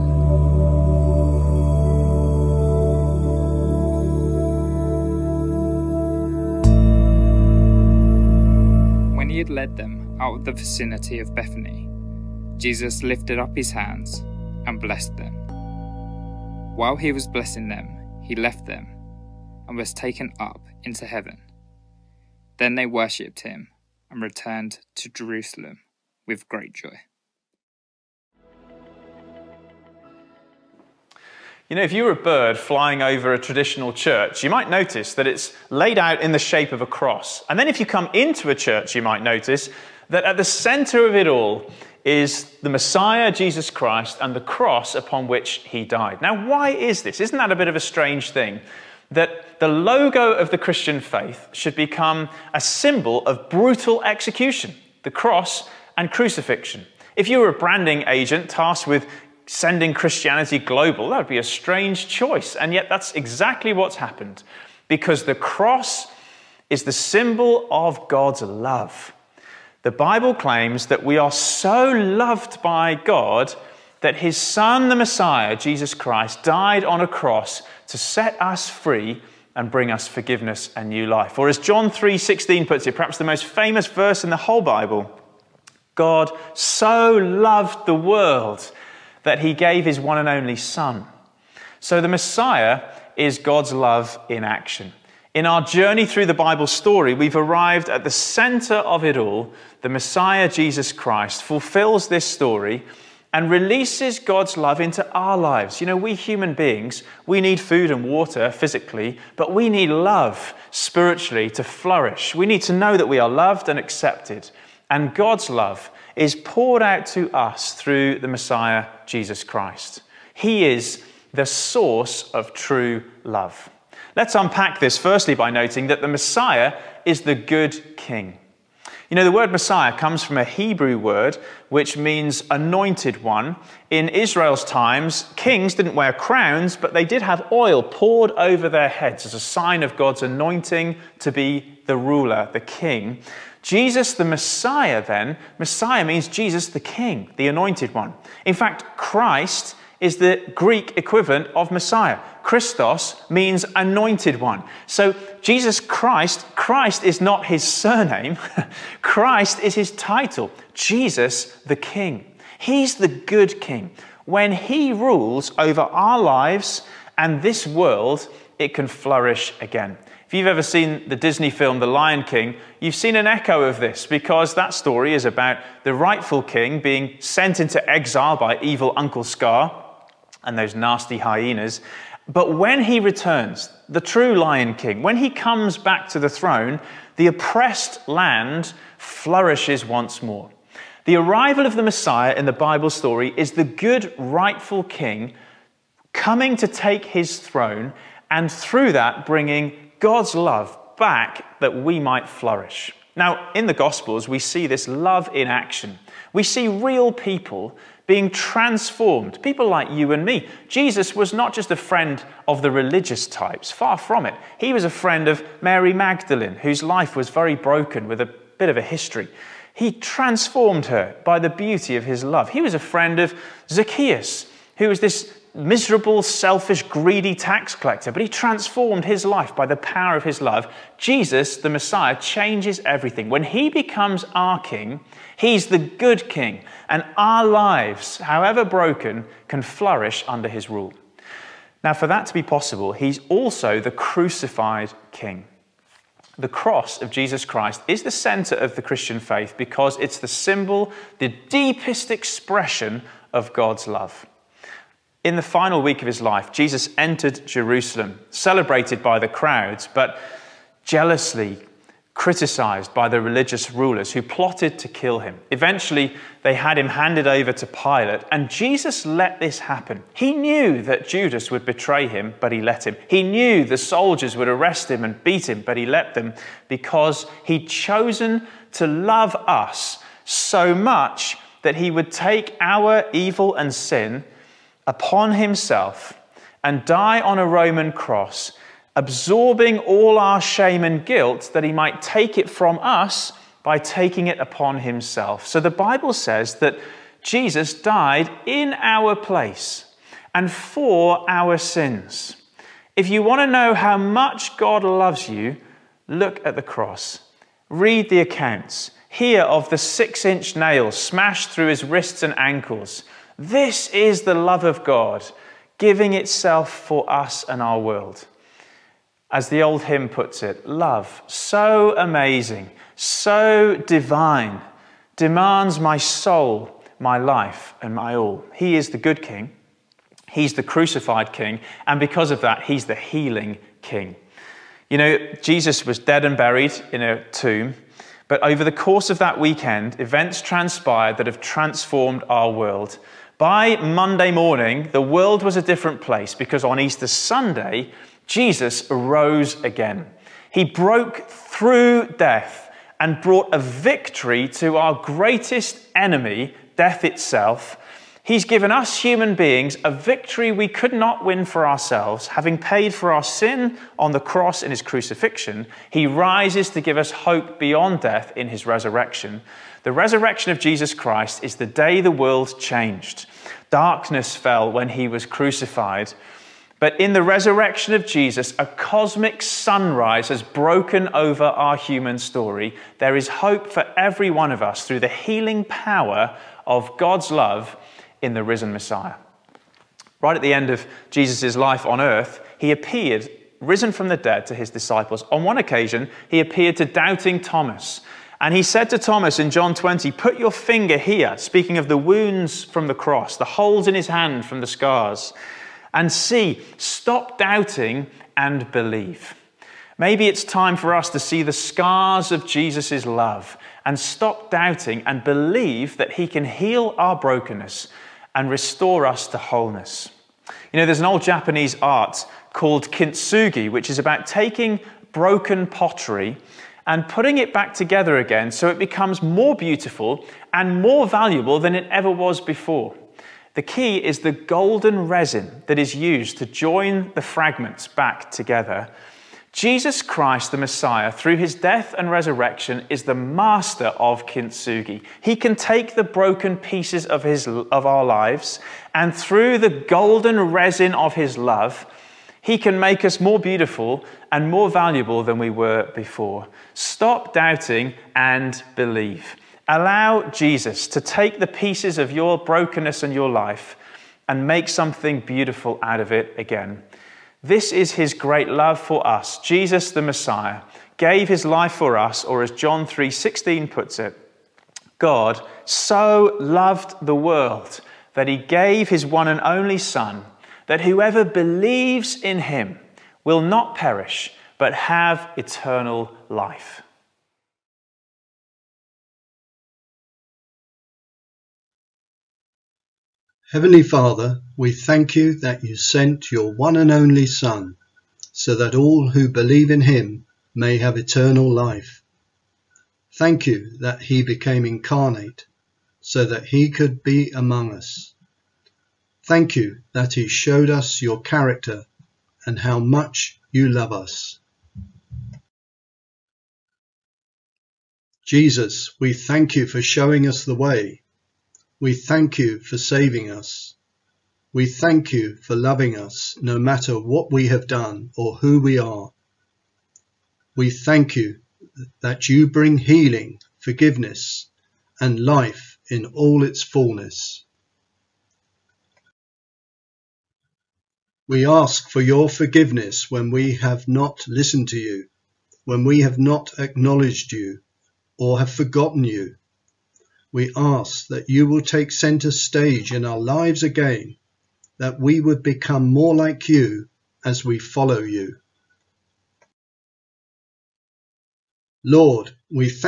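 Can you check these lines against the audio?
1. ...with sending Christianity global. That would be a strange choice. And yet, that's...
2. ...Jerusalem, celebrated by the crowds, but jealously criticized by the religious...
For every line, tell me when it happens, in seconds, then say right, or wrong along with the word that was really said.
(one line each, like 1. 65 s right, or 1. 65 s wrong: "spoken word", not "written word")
1. 58 s right
2. 257 s right.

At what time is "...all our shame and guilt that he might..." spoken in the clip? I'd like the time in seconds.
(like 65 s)
289 s.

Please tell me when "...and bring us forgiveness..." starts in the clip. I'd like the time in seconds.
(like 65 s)
79 s.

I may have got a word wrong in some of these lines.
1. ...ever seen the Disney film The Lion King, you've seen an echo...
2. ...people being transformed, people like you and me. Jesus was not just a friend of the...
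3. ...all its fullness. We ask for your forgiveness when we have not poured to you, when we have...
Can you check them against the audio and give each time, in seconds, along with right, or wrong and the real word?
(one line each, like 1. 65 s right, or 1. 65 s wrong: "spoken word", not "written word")
1. 170 s right
2. 207 s right
3. 536 s wrong: "listened", not "poured".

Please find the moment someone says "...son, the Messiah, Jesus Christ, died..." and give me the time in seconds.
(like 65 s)
74 s.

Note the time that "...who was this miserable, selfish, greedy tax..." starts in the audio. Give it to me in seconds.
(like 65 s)
224 s.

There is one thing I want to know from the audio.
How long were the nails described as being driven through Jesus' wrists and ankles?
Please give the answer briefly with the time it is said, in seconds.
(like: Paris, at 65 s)
6 inch, at 309 s.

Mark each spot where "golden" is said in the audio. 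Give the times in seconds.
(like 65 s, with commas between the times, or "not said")
434 s, 449 s.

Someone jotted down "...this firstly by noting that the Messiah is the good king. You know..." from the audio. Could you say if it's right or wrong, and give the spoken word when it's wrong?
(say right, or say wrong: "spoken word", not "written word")
right.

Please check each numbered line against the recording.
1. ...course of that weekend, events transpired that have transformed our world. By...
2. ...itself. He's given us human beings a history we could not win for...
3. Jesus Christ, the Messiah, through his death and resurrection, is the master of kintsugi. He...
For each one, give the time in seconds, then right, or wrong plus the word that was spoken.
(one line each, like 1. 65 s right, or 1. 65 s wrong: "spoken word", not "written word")
1. 338 s right
2. 357 s wrong: "victory", not "history"
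3. 439 s right.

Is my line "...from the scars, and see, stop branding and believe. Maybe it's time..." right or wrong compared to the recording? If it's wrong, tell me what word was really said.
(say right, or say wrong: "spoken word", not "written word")
wrong: "doubting", not "branding".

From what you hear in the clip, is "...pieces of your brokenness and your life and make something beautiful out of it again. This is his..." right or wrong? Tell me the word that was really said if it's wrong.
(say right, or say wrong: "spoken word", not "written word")
right.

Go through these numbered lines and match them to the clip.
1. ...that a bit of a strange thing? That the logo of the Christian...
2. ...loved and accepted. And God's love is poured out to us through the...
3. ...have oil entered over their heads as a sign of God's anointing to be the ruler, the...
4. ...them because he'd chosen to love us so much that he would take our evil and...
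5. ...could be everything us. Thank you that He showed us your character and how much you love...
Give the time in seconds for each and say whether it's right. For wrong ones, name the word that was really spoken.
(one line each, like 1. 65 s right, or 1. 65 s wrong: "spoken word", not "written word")
1. 47 s right
2. 113 s right
3. 137 s wrong: "poured", not "entered"
4. 276 s right
5. 506 s wrong: "among", not "everything".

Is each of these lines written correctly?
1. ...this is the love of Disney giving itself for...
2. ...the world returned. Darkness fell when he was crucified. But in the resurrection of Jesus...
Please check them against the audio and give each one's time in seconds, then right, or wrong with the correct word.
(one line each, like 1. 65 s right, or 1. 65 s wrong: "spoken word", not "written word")
1. 313 s wrong: "God", not "Disney"
2. 372 s wrong: "changed", not "returned".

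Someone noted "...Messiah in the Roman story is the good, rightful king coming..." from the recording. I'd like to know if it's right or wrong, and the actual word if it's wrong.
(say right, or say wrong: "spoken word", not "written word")
wrong: "Bible", not "Roman".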